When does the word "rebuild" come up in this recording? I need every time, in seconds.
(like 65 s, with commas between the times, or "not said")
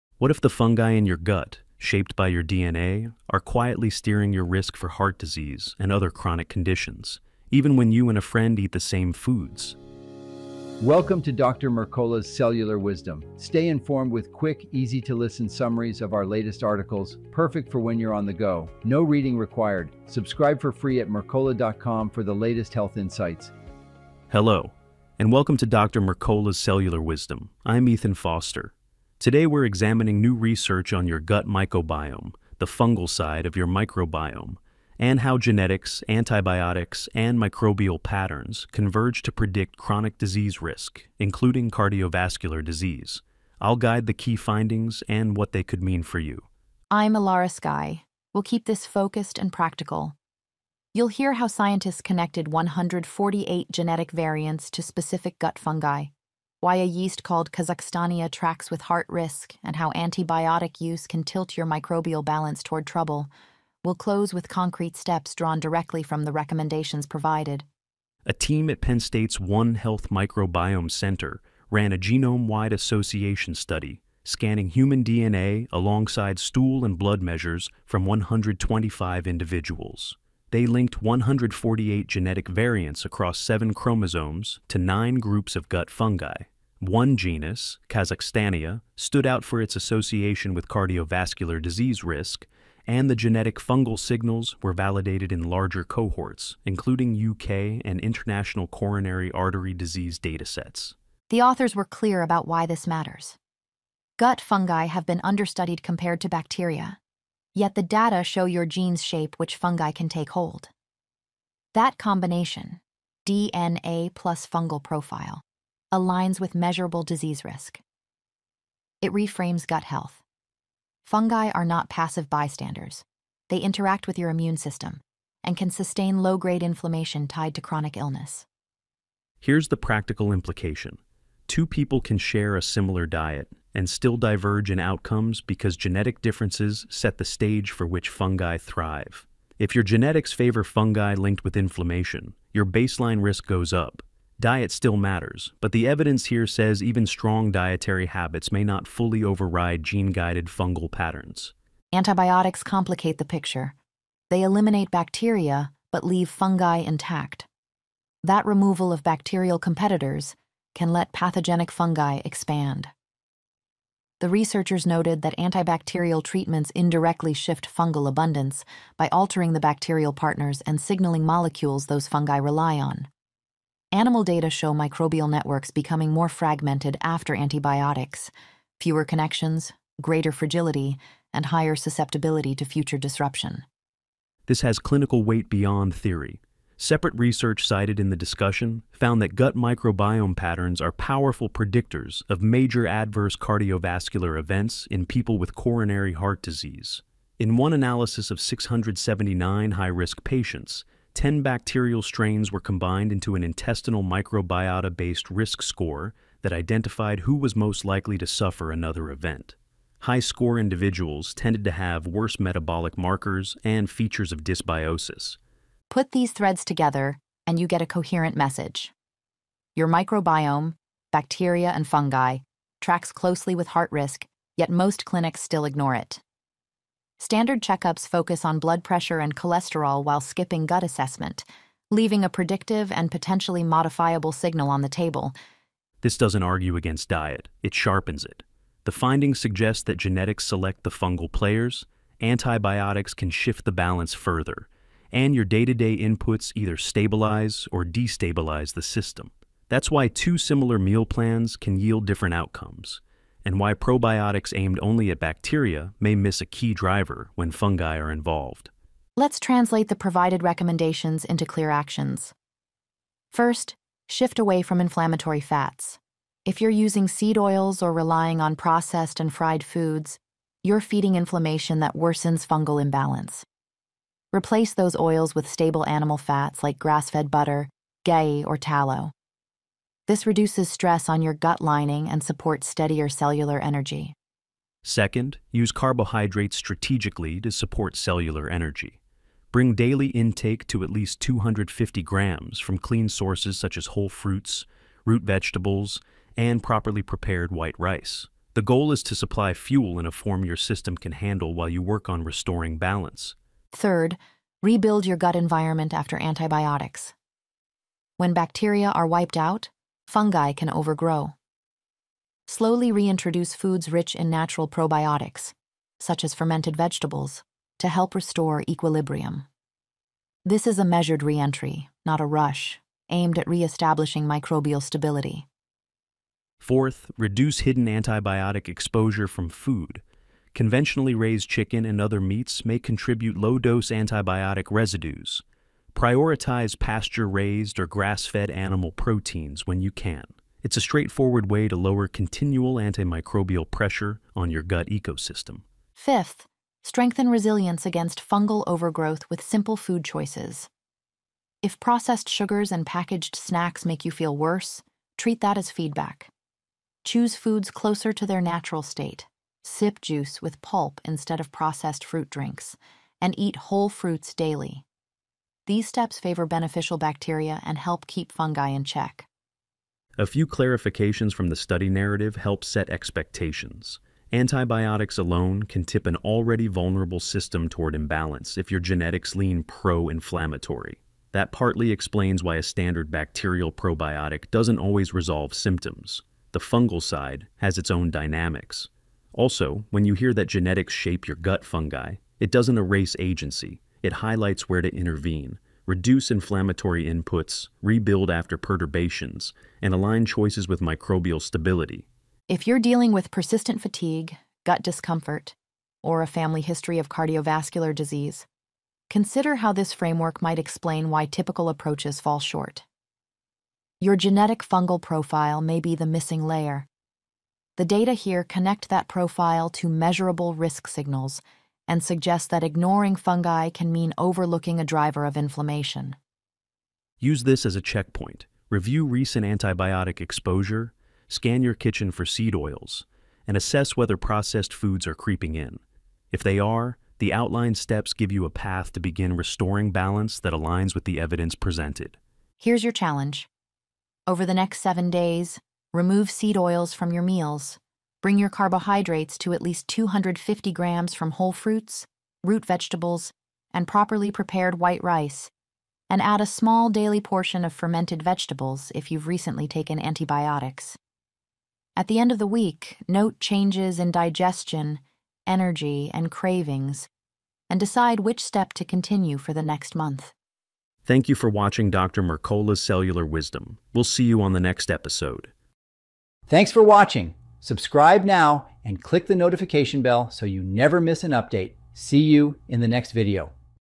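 304 s, 397 s.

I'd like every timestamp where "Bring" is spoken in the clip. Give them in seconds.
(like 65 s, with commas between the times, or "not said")
289 s, 448 s.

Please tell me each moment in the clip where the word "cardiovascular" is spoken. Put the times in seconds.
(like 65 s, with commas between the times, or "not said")
41 s, 90 s, 193 s, 407 s.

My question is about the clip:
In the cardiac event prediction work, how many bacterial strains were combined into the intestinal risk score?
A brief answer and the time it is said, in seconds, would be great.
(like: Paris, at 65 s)
10, at 201 s.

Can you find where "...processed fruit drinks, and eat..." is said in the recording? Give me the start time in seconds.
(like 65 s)
361 s.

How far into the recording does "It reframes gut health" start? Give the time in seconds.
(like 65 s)
119 s.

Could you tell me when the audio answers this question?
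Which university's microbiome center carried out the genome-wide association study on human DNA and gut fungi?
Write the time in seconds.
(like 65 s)
68 s.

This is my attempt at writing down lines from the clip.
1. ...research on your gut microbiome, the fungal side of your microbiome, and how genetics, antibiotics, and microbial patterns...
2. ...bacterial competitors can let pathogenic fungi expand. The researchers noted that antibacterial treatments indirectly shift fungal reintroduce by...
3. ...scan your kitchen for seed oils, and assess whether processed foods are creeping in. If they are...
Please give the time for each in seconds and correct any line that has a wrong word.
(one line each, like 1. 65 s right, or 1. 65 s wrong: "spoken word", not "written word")
1. 30 s right
2. 159 s wrong: "abundance", not "reintroduce"
3. 431 s right.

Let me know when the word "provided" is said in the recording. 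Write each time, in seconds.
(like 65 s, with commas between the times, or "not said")
67 s, 259 s.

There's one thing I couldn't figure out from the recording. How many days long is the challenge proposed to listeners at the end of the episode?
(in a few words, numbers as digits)
7.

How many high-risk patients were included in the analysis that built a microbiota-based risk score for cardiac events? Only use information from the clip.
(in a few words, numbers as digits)
679.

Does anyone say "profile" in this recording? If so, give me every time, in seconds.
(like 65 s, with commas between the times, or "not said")
114 s, 414 s, 419 s.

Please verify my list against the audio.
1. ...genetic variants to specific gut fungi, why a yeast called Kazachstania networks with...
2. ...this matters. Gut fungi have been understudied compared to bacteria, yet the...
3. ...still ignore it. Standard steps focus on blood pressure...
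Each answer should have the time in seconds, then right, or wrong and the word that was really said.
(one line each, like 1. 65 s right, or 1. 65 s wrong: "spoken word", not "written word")
1. 53 s wrong: "tracks", not "networks"
2. 102 s right
3. 225 s wrong: "checkups", not "steps".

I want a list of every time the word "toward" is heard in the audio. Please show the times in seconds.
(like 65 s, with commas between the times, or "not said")
62 s, 377 s.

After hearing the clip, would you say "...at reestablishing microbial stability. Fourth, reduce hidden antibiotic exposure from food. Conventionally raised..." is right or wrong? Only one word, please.
right.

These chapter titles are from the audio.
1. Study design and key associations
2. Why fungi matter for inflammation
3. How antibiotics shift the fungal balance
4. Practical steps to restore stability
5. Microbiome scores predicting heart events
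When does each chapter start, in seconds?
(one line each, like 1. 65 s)
1. 47 s
2. 107 s
3. 139 s
4. 259 s
5. 209 s.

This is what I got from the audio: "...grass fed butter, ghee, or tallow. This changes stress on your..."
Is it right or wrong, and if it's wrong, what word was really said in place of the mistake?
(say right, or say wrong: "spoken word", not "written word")
wrong: "reduces", not "changes".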